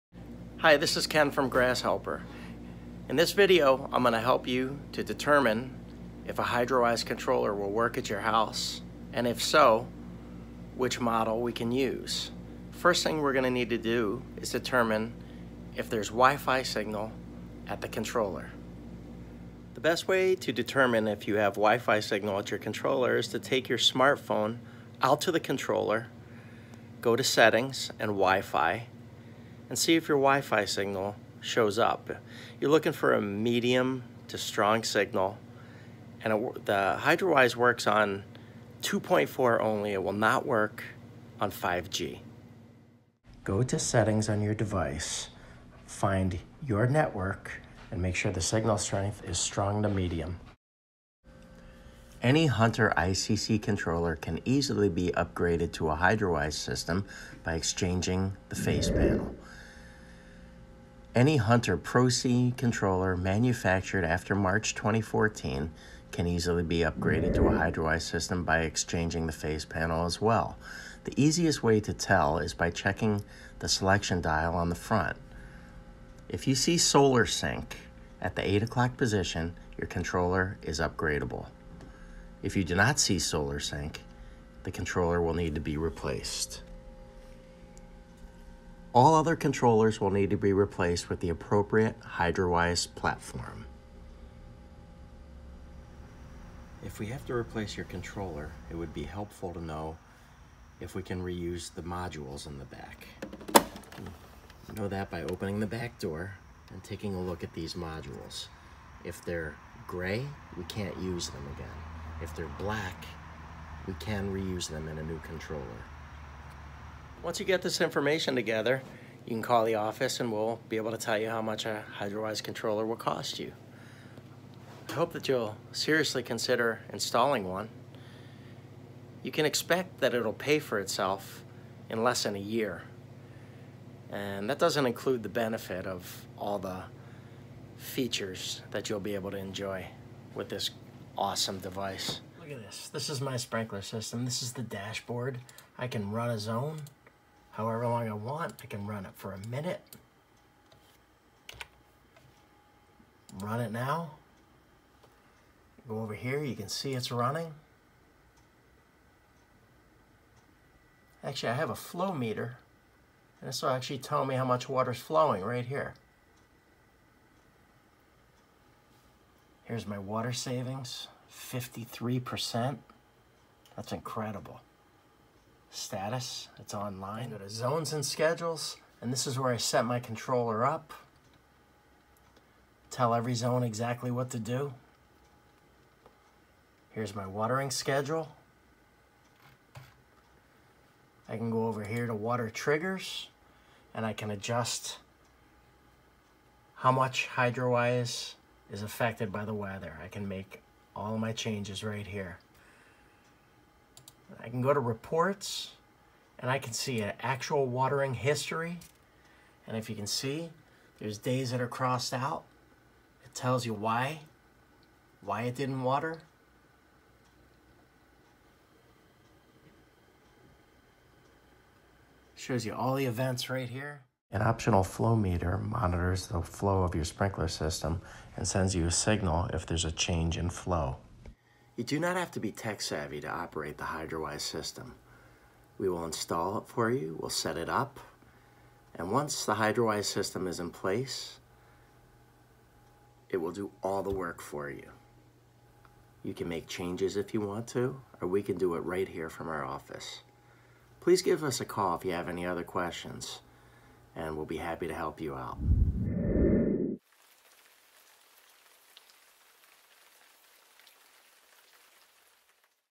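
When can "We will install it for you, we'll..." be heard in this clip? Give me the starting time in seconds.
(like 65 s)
235 s.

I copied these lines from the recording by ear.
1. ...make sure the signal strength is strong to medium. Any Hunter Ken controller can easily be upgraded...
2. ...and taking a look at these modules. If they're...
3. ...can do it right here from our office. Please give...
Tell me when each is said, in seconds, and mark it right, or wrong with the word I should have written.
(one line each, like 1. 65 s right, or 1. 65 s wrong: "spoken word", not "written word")
1. 48 s wrong: "ICC", not "Ken"
2. 106 s right
3. 248 s right.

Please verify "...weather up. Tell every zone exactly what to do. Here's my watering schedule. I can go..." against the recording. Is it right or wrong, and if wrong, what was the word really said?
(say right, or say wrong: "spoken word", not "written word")
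wrong: "controller", not "weather".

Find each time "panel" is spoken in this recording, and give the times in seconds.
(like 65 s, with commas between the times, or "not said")
58 s, 69 s.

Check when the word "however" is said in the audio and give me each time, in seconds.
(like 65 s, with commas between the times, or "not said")
147 s.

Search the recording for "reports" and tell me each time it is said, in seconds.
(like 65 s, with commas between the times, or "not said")
204 s.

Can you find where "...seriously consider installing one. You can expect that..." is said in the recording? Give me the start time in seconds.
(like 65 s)
125 s.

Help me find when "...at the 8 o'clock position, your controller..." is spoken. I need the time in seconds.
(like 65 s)
78 s.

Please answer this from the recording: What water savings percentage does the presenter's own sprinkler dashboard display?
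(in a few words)
53%.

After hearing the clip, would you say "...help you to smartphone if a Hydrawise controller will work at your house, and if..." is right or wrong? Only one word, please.
wrong.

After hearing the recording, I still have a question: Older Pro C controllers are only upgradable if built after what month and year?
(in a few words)
March 2014.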